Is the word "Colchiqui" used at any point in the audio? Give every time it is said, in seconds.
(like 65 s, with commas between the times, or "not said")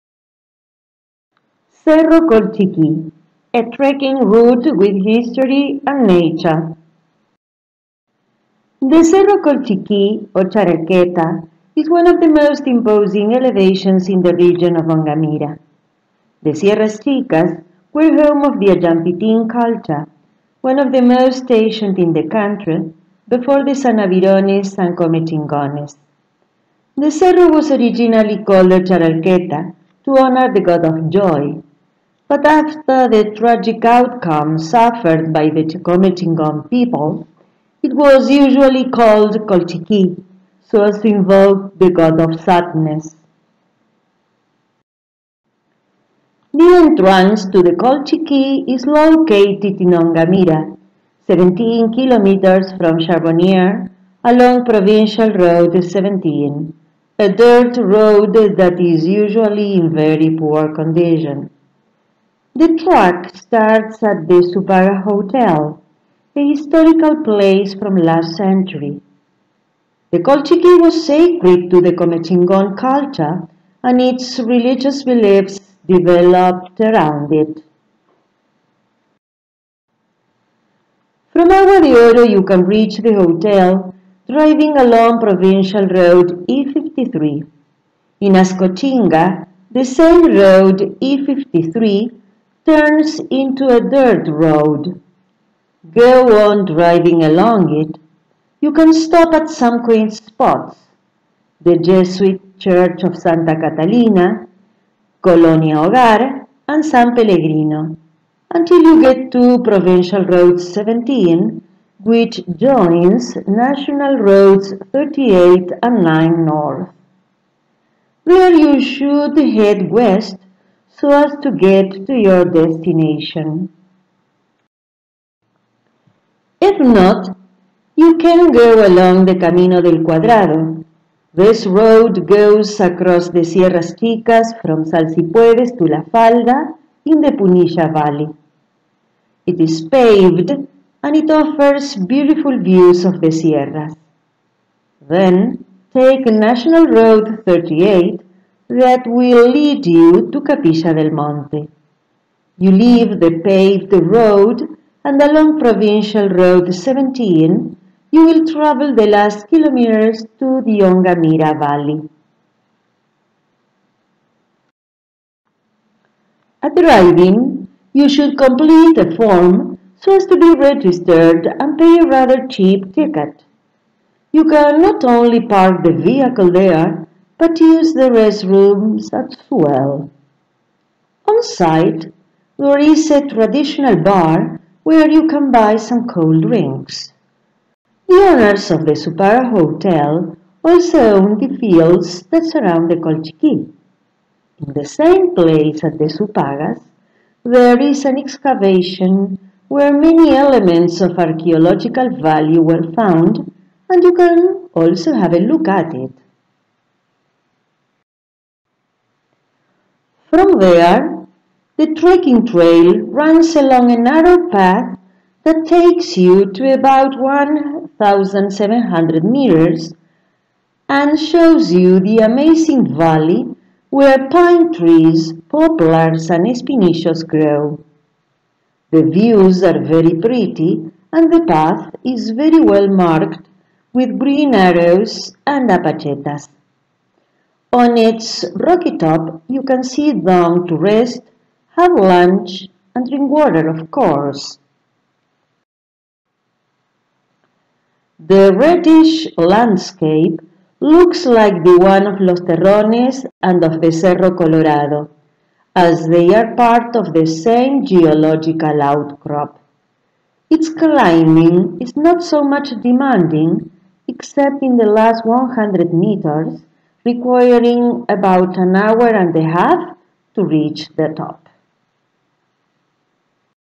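2 s, 9 s, 39 s, 47 s, 70 s, 193 s.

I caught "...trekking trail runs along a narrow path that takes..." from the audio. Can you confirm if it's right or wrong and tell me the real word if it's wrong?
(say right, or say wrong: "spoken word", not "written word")
right.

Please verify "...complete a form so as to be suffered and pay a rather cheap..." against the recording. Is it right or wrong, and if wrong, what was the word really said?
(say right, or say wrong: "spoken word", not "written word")
wrong: "registered", not "suffered".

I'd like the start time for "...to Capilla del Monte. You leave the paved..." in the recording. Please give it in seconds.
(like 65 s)
150 s.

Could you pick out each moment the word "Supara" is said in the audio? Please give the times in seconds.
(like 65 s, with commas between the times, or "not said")
189 s, 196 s.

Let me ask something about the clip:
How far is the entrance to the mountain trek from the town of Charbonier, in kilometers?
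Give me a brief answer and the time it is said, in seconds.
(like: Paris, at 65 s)
17, at 51 s.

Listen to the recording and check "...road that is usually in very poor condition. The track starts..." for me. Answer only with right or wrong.
right.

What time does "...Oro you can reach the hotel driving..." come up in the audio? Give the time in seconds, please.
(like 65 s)
82 s.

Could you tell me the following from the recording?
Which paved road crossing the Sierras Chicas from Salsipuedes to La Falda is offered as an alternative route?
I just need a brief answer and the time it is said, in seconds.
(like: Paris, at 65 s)
Camino del Cuadrado, at 129 s.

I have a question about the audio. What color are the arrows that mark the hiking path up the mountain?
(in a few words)
green.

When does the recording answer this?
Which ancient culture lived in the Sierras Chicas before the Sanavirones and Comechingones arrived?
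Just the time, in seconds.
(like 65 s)
18 s.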